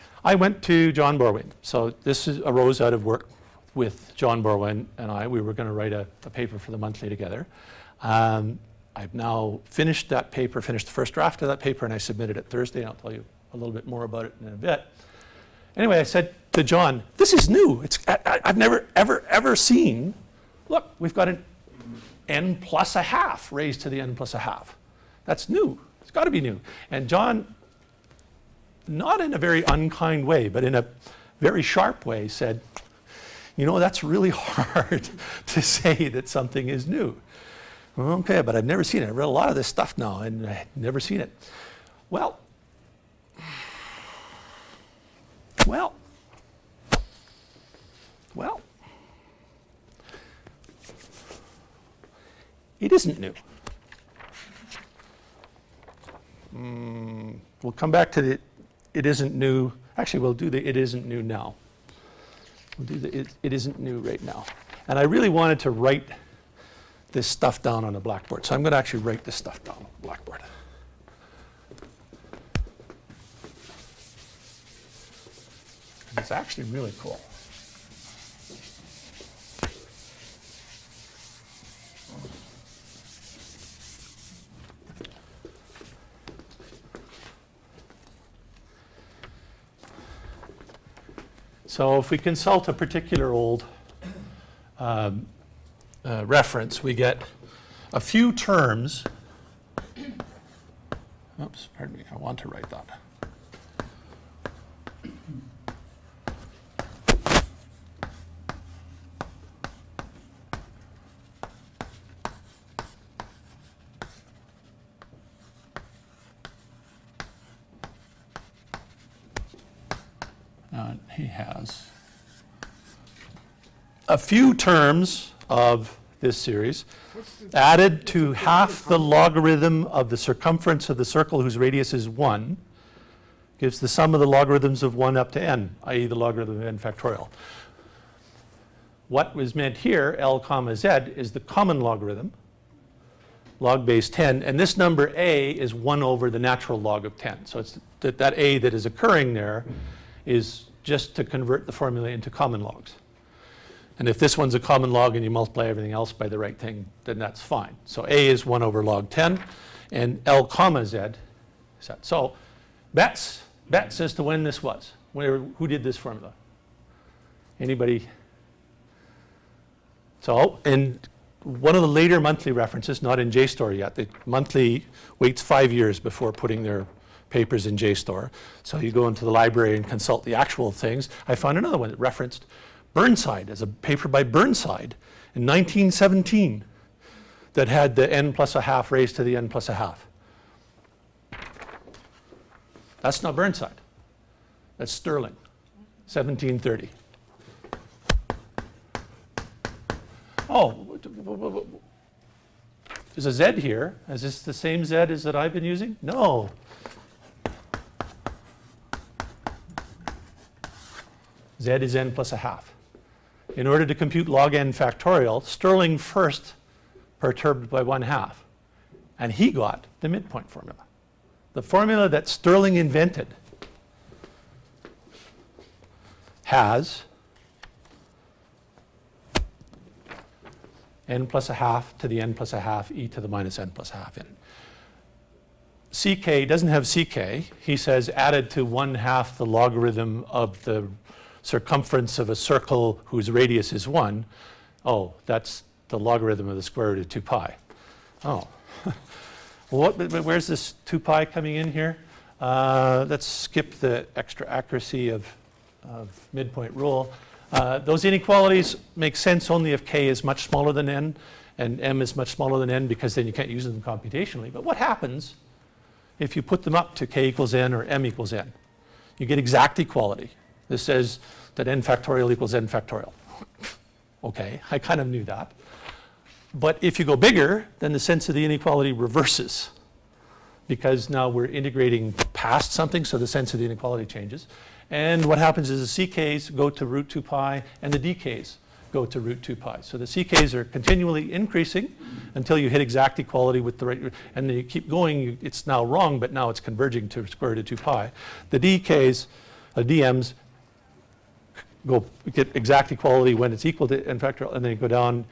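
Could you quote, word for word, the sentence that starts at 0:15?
Anyway, I said to John, this is new.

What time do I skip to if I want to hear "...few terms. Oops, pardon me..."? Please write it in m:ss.
1:37.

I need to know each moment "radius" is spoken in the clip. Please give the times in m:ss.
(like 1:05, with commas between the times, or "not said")
2:11, 4:03.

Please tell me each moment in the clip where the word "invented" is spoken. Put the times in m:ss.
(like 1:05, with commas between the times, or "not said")
3:42.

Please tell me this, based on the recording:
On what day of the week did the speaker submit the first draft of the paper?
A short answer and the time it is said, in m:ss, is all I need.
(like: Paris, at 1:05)
Thursday, at 0:12.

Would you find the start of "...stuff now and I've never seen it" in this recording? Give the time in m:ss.
0:39.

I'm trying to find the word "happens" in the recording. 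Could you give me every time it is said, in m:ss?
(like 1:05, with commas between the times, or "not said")
4:24, 4:45.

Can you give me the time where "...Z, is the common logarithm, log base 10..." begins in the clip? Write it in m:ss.
2:20.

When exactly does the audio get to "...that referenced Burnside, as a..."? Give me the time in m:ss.
3:01.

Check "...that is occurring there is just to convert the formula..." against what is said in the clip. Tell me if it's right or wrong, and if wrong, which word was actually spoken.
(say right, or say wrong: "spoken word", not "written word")
right.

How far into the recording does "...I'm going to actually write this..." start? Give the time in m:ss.
1:08.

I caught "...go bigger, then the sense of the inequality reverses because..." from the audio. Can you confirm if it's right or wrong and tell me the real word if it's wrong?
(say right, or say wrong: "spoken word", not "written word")
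right.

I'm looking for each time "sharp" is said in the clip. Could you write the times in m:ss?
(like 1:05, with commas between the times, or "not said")
0:31.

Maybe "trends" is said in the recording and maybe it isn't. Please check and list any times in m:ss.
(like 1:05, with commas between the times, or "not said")
not said.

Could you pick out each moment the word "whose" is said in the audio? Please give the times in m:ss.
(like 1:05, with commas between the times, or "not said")
2:11, 4:03.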